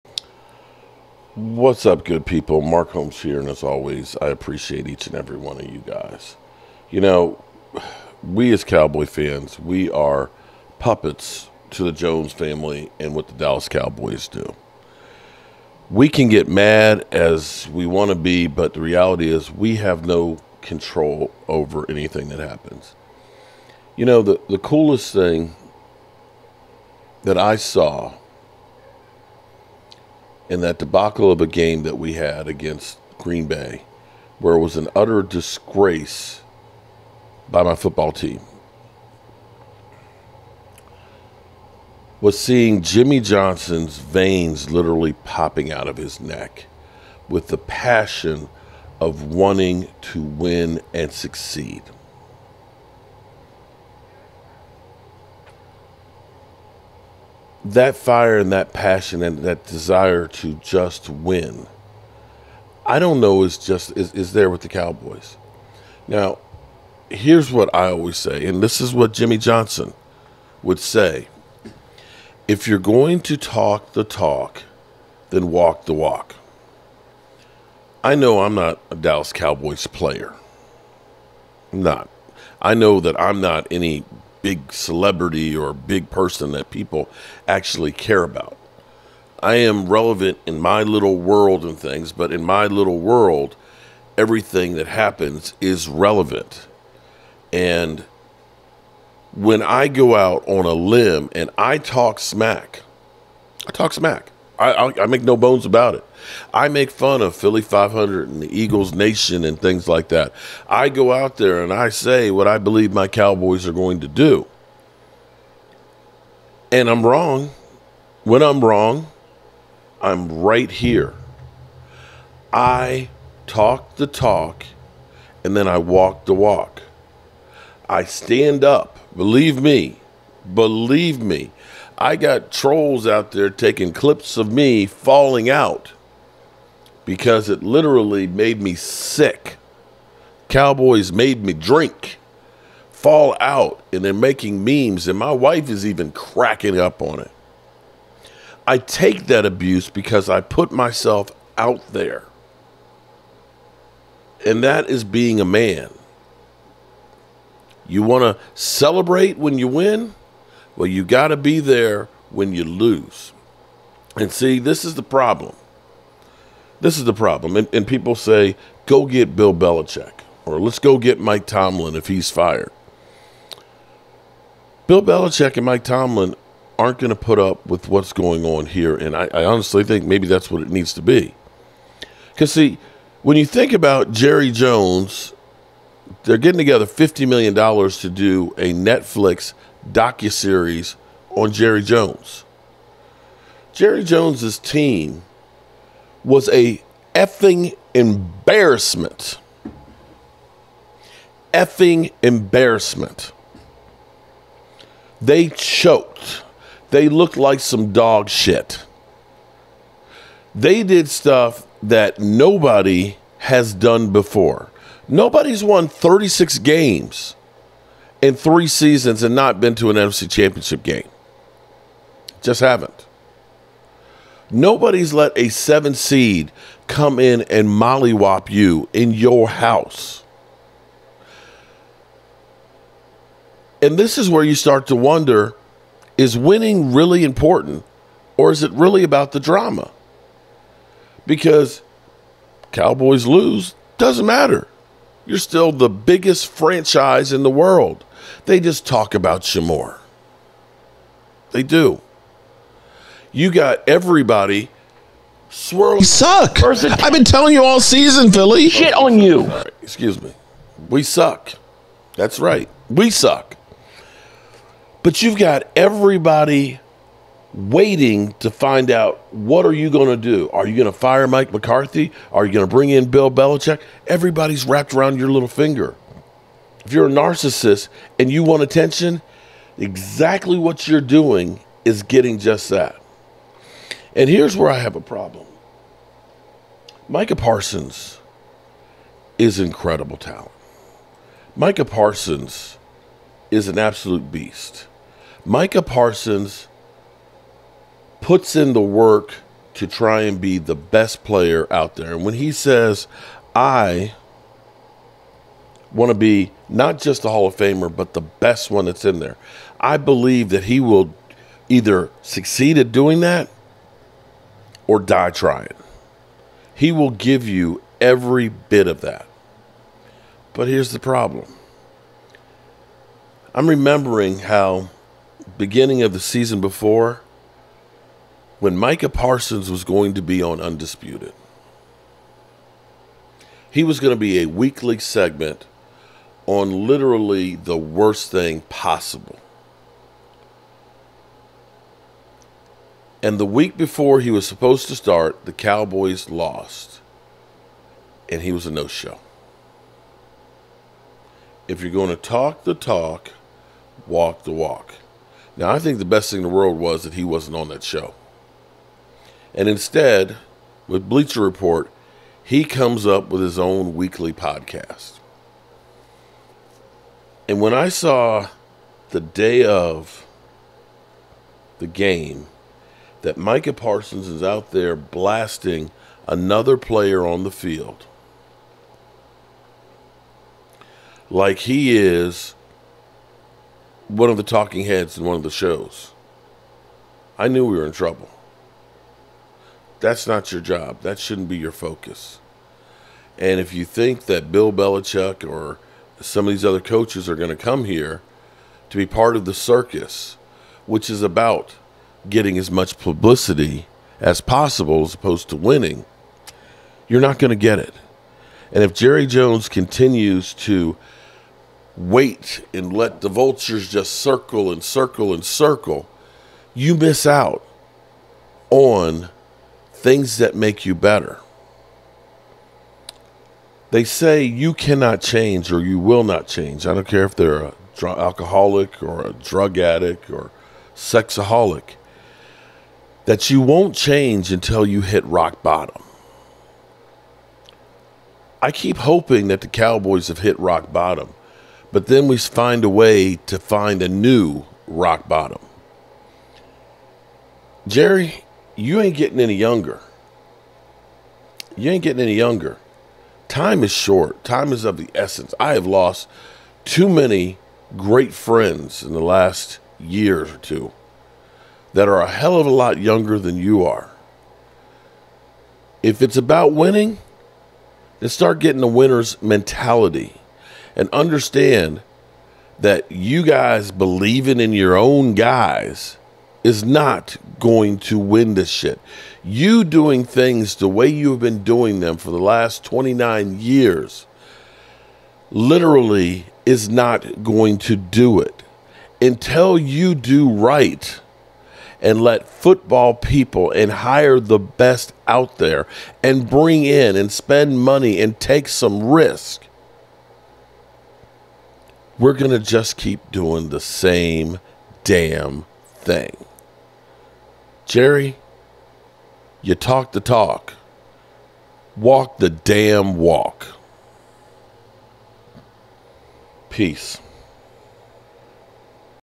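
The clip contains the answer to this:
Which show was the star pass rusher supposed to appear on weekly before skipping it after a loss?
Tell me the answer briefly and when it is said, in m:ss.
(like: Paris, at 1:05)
Undisputed, at 5:30.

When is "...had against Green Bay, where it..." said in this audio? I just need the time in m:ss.
0:32.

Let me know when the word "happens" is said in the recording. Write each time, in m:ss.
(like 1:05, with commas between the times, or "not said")
0:22, 1:34.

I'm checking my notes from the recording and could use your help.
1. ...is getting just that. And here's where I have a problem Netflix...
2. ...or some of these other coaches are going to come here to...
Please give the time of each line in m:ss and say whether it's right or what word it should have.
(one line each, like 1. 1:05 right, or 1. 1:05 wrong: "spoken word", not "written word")
1. 4:41 wrong: "Micah", not "Netflix"
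2. 6:35 right.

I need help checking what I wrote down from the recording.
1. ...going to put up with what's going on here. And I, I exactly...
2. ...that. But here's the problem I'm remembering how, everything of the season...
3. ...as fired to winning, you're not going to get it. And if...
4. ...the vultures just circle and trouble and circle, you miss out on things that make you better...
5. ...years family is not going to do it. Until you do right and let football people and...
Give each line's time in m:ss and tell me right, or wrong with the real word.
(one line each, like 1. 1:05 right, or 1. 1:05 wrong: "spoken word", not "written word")
1. 2:56 wrong: "honestly", not "exactly"
2. 5:19 wrong: "beginning", not "everything"
3. 6:45 wrong: "opposed", not "fired"
4. 6:53 wrong: "circle", not "trouble"
5. 8:03 wrong: "literally", not "family".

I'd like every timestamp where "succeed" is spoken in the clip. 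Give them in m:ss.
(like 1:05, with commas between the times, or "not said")
0:51, 5:12.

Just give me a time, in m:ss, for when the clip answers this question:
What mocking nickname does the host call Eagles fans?
1:47.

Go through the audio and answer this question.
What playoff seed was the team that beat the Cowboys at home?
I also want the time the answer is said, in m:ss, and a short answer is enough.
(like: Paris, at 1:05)
seven, at 3:45.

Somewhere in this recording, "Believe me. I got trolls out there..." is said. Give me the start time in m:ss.
2:10.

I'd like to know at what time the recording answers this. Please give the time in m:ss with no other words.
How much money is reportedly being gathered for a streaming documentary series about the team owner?
3:06.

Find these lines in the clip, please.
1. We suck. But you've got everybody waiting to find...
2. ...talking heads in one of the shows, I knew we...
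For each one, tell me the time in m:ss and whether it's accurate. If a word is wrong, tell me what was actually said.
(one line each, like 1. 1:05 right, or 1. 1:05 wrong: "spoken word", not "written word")
1. 4:22 right
2. 6:24 right.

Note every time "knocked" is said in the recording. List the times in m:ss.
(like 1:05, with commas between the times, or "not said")
not said.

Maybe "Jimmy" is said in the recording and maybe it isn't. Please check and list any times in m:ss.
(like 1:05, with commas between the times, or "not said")
0:42, 1:09.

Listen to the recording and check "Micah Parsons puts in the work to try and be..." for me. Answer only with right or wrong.
right.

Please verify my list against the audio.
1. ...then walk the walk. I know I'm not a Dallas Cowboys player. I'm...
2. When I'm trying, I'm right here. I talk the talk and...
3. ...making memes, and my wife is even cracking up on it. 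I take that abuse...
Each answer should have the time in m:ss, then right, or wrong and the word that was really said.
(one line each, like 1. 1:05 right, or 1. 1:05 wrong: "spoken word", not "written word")
1. 1:15 right
2. 1:58 wrong: "wrong", not "trying"
3. 2:24 right.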